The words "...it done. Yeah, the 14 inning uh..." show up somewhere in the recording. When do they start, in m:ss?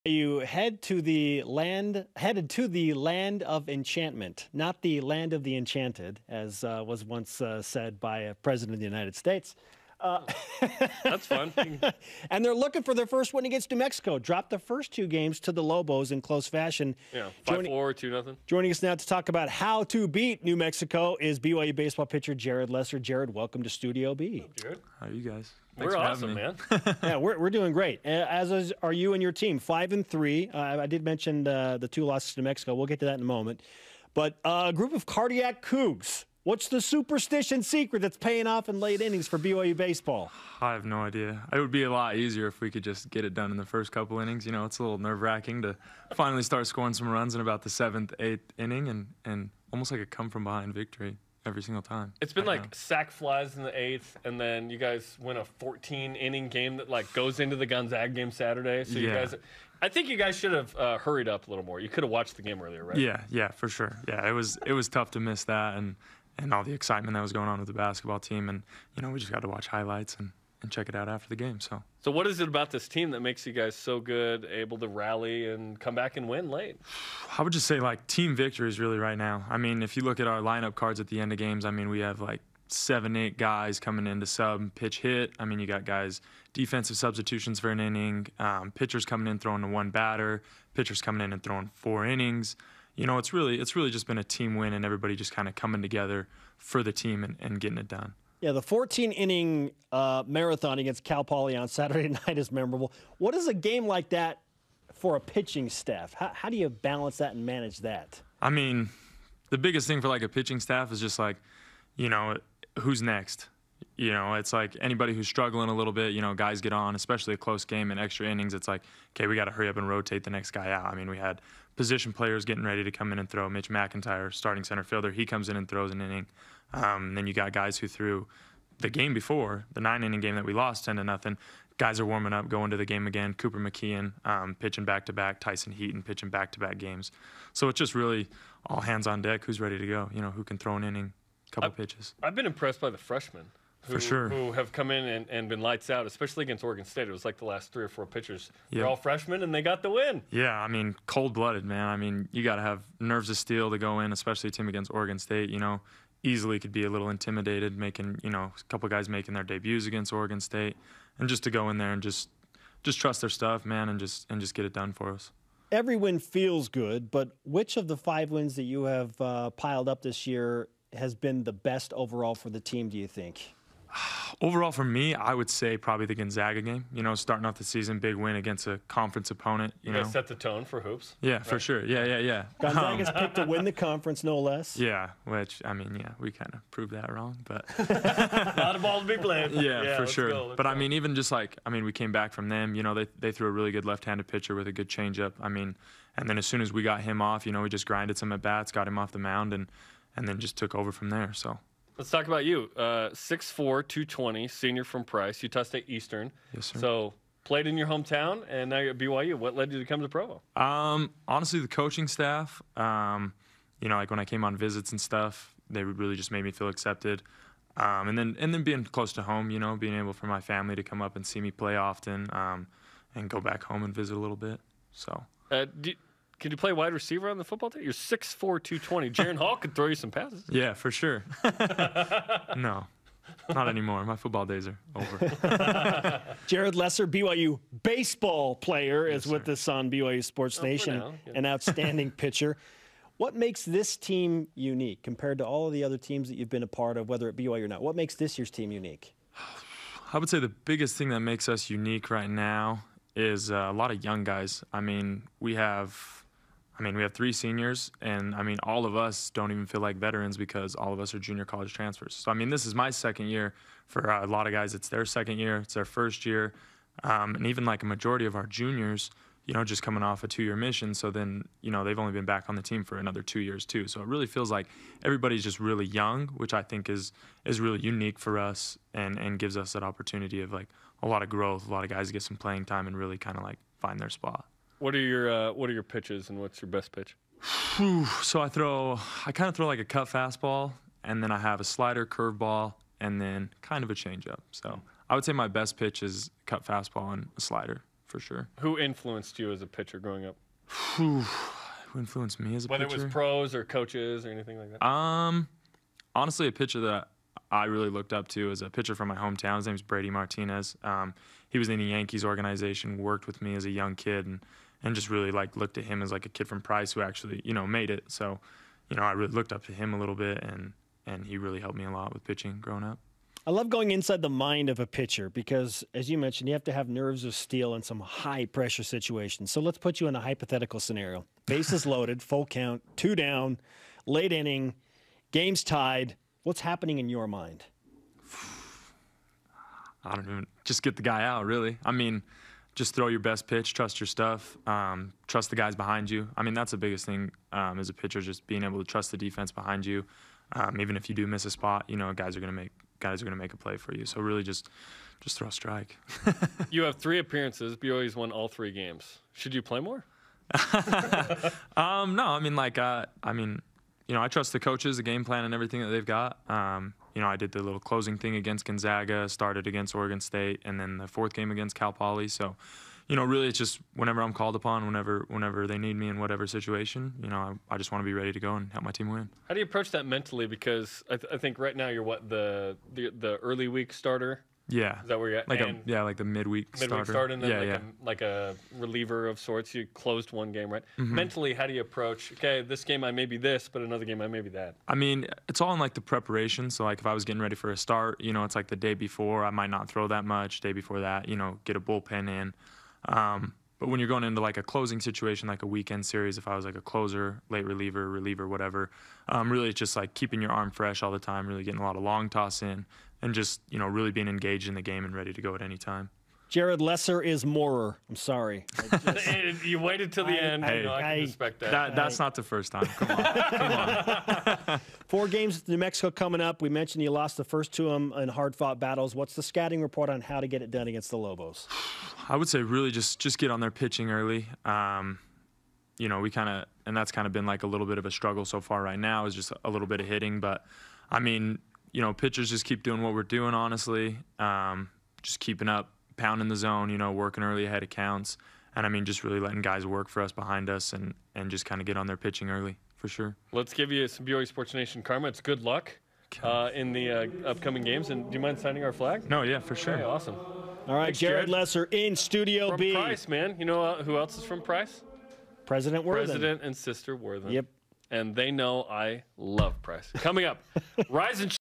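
1:37.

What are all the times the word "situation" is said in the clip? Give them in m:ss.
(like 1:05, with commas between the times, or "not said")
5:28, 6:16, 6:45.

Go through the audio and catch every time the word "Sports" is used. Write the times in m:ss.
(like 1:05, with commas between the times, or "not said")
4:00, 7:34.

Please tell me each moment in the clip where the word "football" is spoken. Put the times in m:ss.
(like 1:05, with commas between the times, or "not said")
3:47, 3:54.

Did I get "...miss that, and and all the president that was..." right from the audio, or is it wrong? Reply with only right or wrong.
wrong.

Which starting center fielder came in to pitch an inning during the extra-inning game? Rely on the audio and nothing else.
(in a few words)
Mitch McIntyre.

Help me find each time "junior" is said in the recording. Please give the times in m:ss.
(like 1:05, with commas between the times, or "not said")
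4:21, 4:28.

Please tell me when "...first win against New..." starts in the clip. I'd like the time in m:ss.
0:13.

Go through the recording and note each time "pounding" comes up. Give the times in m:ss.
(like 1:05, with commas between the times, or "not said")
7:26.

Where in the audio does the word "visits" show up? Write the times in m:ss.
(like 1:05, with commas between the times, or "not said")
3:34, 3:43.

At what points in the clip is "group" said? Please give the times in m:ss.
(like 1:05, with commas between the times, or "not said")
0:34.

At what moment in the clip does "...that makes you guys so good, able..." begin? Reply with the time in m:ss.
1:13.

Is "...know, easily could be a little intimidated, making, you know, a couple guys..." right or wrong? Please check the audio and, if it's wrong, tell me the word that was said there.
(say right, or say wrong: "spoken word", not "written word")
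right.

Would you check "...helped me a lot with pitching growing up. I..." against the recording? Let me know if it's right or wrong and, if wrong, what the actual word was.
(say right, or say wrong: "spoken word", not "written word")
right.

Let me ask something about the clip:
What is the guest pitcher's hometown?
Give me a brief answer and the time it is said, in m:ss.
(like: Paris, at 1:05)
Price, Utah, at 3:25.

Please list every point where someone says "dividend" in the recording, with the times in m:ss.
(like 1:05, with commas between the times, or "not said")
not said.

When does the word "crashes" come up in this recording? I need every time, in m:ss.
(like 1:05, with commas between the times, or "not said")
not said.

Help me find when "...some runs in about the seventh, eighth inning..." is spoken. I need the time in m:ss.
0:46.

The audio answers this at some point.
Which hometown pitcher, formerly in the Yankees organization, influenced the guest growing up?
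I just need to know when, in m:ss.
5:09.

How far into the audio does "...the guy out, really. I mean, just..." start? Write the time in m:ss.
5:40.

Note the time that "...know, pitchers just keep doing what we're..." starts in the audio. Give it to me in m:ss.
7:22.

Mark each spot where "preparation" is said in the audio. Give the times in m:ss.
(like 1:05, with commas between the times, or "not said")
6:36.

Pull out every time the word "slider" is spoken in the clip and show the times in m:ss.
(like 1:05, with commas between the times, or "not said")
4:51, 4:57.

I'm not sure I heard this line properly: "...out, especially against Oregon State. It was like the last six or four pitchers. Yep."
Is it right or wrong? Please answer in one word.
wrong.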